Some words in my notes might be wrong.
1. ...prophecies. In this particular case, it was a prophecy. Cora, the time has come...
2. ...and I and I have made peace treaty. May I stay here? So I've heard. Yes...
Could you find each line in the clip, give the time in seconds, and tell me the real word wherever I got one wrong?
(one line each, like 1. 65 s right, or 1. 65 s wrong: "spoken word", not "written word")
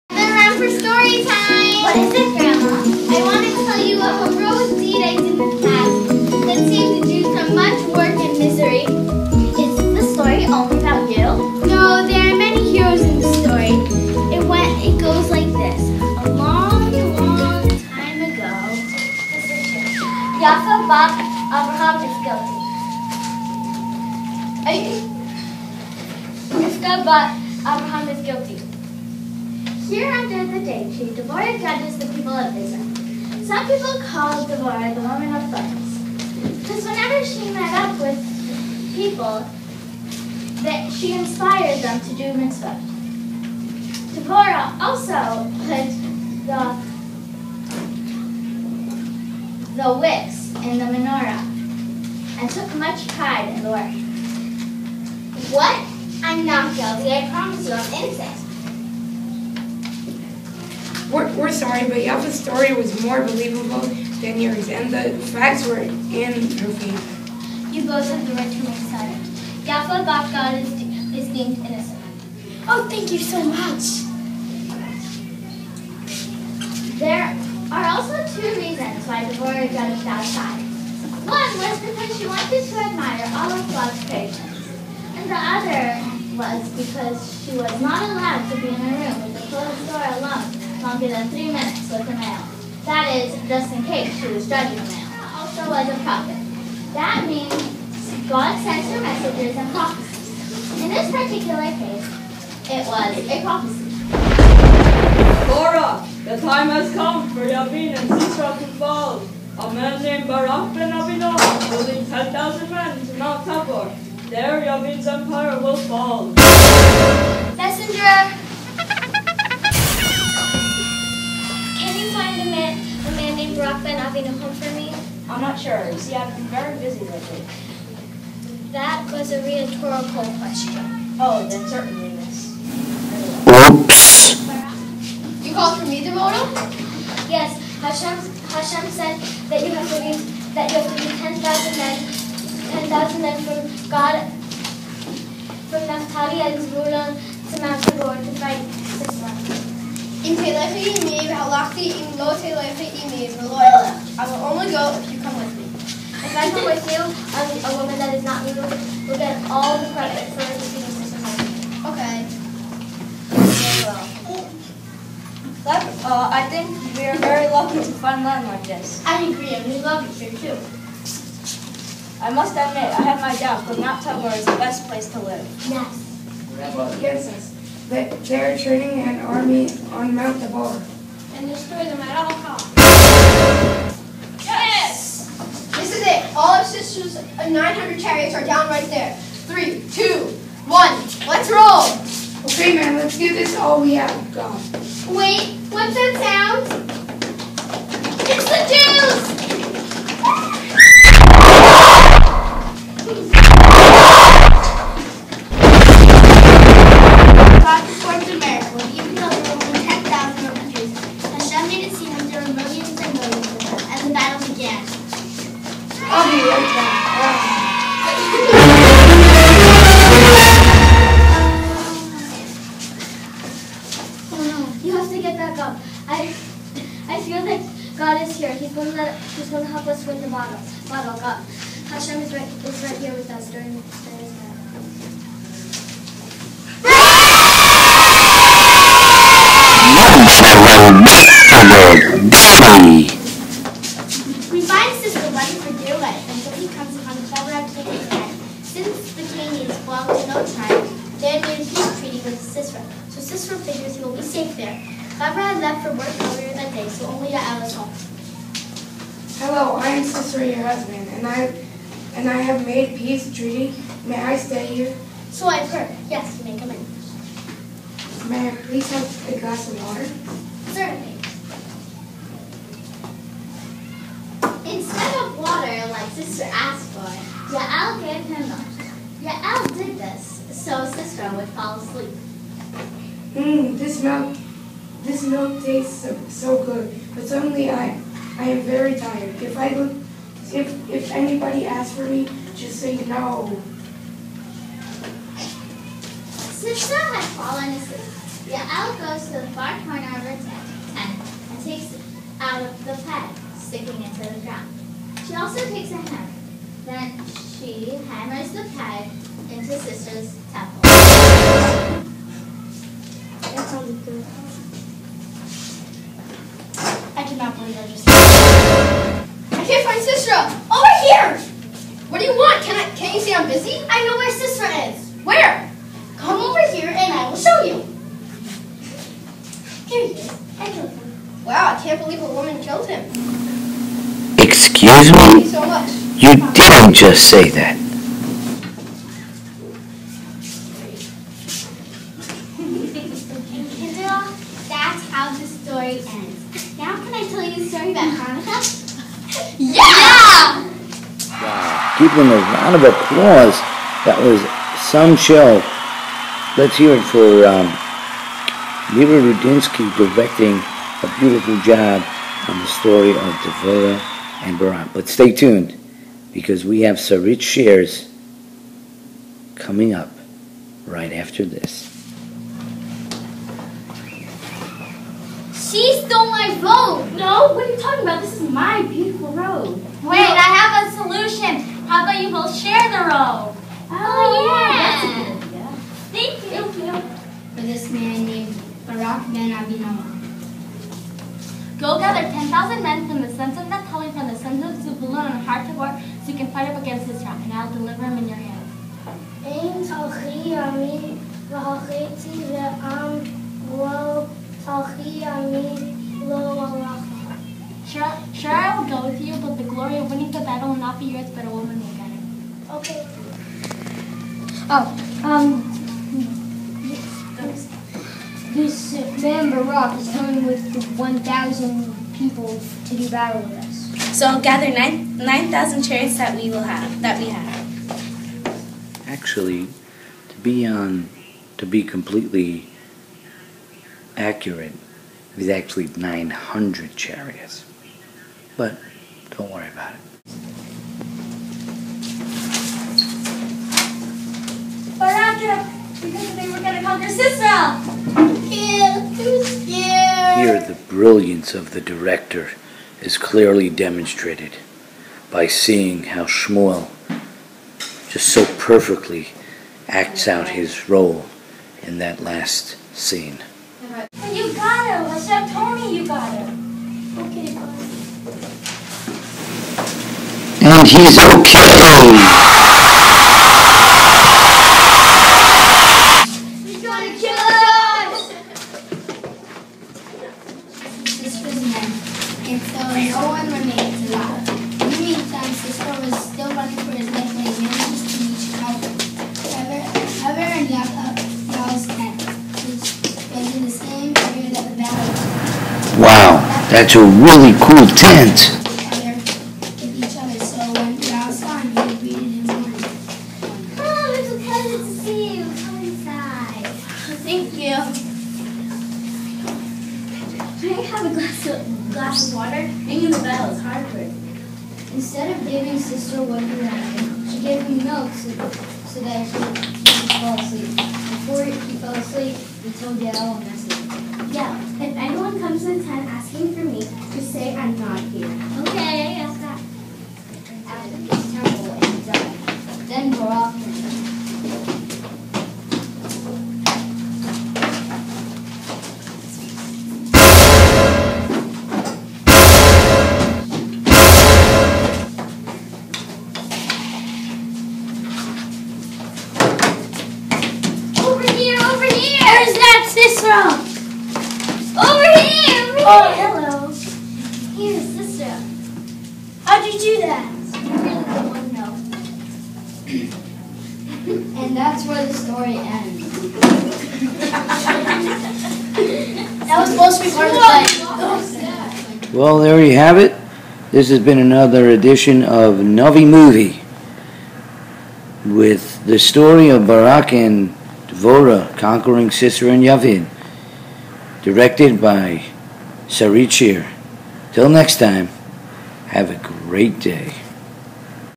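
1. 99 s right
2. 261 s right.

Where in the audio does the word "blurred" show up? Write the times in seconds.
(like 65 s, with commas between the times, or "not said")
not said.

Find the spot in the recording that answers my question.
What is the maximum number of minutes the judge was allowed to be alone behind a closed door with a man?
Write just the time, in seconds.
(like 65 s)
91 s.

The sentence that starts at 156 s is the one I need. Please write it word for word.
If I come with you, I'm a woman that is not evil, will get all the credit for everything this is Okay.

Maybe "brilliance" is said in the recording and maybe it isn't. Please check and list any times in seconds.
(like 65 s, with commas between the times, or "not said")
450 s.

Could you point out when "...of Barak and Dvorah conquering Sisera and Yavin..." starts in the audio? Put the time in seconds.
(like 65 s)
579 s.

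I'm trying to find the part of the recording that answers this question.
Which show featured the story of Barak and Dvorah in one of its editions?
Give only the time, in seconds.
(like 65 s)
575 s.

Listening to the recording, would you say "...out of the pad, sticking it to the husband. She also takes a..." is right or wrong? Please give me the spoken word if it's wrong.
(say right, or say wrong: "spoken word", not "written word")
wrong: "ground", not "husband".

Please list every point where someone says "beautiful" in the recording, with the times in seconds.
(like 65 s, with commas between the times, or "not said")
361 s, 378 s.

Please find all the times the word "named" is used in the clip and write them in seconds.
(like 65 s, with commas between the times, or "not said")
110 s, 123 s, 388 s.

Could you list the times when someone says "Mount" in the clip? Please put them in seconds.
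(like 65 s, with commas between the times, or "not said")
113 s, 147 s, 173 s, 180 s.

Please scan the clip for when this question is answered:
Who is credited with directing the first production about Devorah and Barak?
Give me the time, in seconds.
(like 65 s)
358 s.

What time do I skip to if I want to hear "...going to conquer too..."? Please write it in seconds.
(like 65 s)
446 s.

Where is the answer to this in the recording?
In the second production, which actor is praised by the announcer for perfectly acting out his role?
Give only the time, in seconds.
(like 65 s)
456 s.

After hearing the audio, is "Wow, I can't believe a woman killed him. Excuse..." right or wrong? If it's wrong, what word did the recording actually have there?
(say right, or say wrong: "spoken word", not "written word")
right.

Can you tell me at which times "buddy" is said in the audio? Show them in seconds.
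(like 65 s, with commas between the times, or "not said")
not said.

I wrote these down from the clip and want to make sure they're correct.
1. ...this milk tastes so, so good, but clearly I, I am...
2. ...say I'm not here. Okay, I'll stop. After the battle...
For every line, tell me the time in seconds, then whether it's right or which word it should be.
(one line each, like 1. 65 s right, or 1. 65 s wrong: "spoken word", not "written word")
1. 285 s wrong: "suddenly", not "clearly"
2. 527 s wrong: "temple", not "battle".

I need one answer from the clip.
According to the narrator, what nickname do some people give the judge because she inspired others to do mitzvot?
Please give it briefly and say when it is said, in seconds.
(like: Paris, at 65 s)
the woman of thorns, at 34 s.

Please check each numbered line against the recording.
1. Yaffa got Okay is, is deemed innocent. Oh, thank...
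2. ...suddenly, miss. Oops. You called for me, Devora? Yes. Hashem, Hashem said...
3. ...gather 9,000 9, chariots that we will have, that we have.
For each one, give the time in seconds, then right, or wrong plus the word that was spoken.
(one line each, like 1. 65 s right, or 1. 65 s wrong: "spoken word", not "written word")
1. 69 s wrong: "God", not "Okay"
2. 131 s wrong: "certainly", not "suddenly"
3. 424 s right.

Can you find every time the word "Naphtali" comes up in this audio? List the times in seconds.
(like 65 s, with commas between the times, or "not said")
145 s, 393 s.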